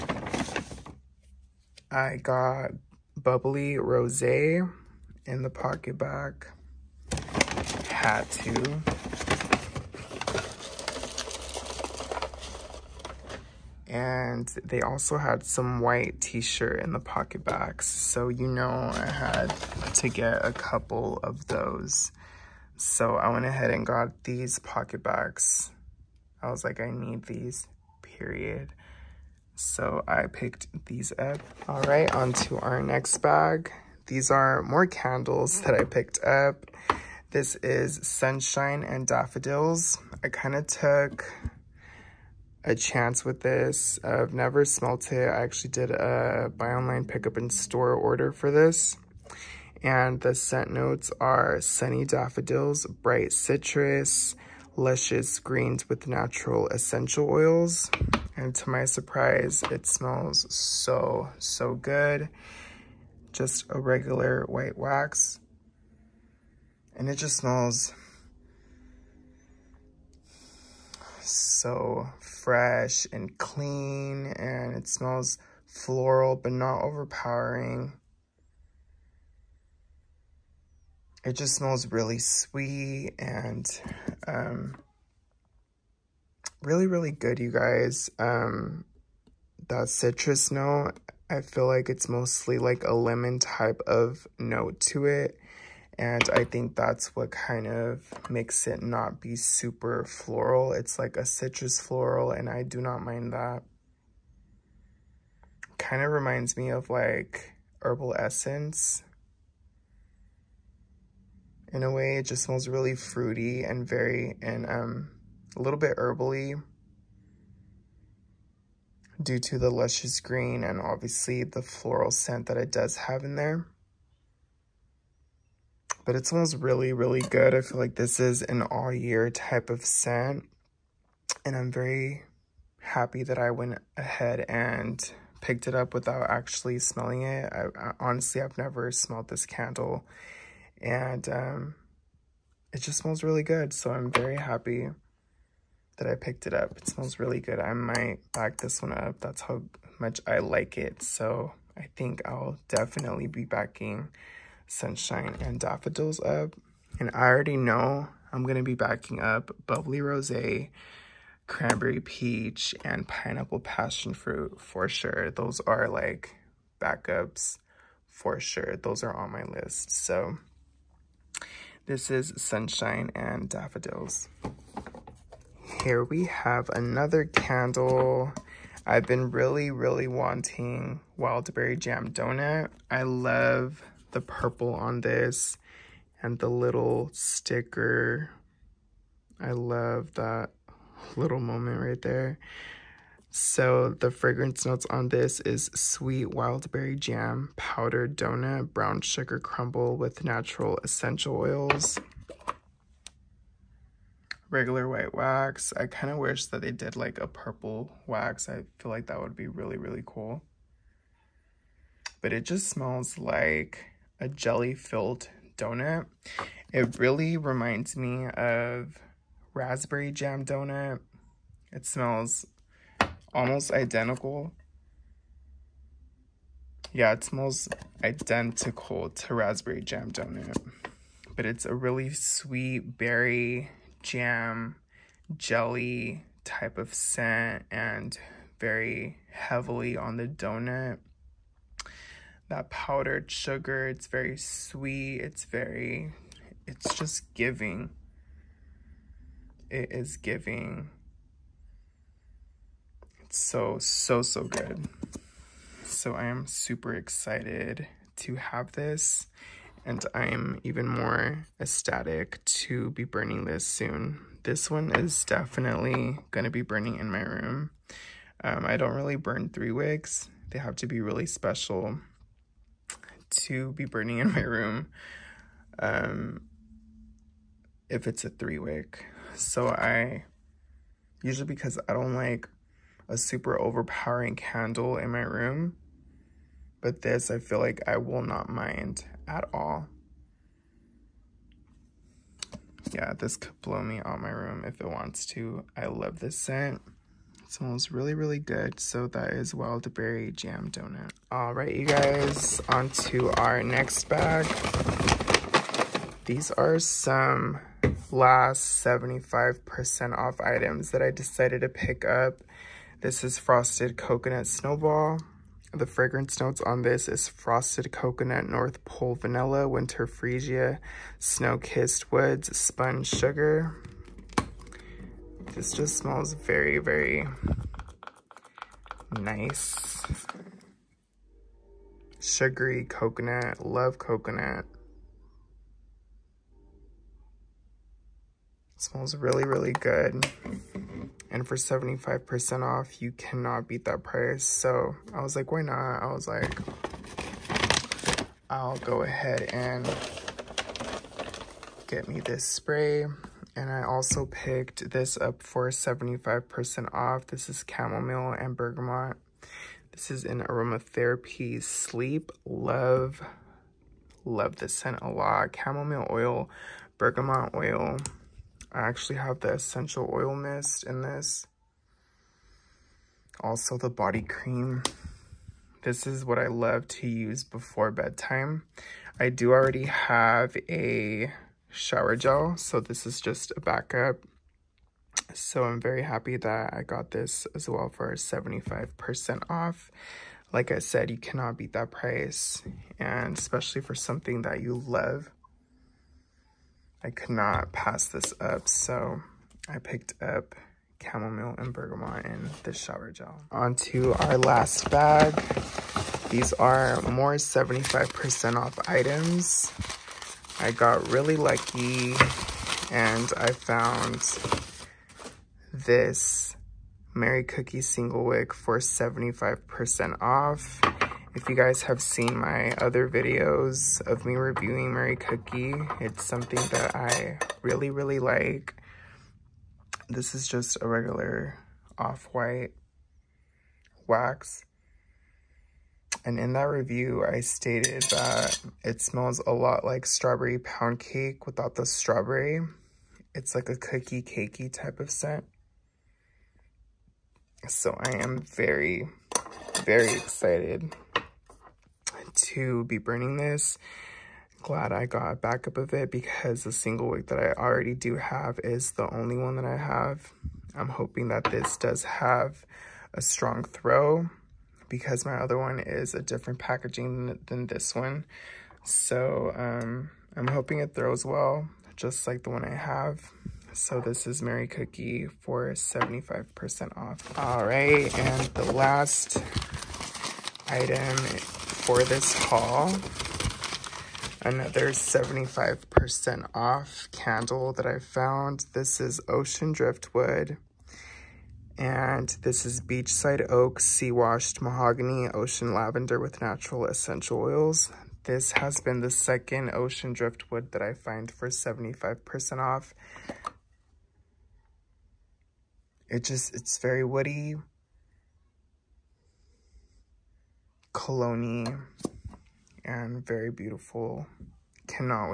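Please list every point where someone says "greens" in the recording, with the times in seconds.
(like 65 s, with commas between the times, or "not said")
55 s, 120 s.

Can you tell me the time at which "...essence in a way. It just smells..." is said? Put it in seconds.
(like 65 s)
108 s.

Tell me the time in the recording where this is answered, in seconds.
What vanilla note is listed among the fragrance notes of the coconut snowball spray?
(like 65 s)
318 s.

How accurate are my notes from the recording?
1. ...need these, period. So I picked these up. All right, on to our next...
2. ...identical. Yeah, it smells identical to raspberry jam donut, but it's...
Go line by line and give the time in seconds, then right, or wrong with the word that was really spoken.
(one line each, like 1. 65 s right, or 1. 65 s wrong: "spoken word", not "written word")
1. 26 s right
2. 223 s right.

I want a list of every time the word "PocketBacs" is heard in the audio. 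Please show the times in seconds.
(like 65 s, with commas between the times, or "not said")
5 s, 16 s, 24 s.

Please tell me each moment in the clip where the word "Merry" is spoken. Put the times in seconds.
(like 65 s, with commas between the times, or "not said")
417 s, 424 s, 474 s.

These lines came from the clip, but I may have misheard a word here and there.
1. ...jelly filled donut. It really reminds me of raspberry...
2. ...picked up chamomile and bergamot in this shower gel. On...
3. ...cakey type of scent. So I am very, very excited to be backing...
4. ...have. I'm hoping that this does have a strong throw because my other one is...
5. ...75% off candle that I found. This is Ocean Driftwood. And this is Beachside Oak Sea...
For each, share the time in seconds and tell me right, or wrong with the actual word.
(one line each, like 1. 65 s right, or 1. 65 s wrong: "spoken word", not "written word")
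1. 214 s right
2. 399 s right
3. 444 s wrong: "burning", not "backing"
4. 459 s right
5. 484 s right.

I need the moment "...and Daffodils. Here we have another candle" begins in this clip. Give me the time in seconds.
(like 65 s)
173 s.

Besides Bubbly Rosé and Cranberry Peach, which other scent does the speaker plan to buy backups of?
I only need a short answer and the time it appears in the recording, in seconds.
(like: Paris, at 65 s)
Pineapple Passion Fruit, at 163 s.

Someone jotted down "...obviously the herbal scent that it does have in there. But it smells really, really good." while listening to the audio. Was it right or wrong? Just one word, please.
wrong.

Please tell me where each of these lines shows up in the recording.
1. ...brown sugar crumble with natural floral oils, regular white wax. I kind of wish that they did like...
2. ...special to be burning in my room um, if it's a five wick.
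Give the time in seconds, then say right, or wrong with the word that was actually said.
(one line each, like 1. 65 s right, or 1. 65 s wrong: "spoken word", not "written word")
1. 198 s wrong: "essential", not "floral"
2. 271 s wrong: "three", not "five".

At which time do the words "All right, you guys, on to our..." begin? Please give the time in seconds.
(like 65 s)
301 s.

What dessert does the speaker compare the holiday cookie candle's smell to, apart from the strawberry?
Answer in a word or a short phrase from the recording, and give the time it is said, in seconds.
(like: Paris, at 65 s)
Strawberry pound cake, at 440 s.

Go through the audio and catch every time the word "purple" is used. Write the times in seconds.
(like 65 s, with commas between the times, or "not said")
184 s, 207 s.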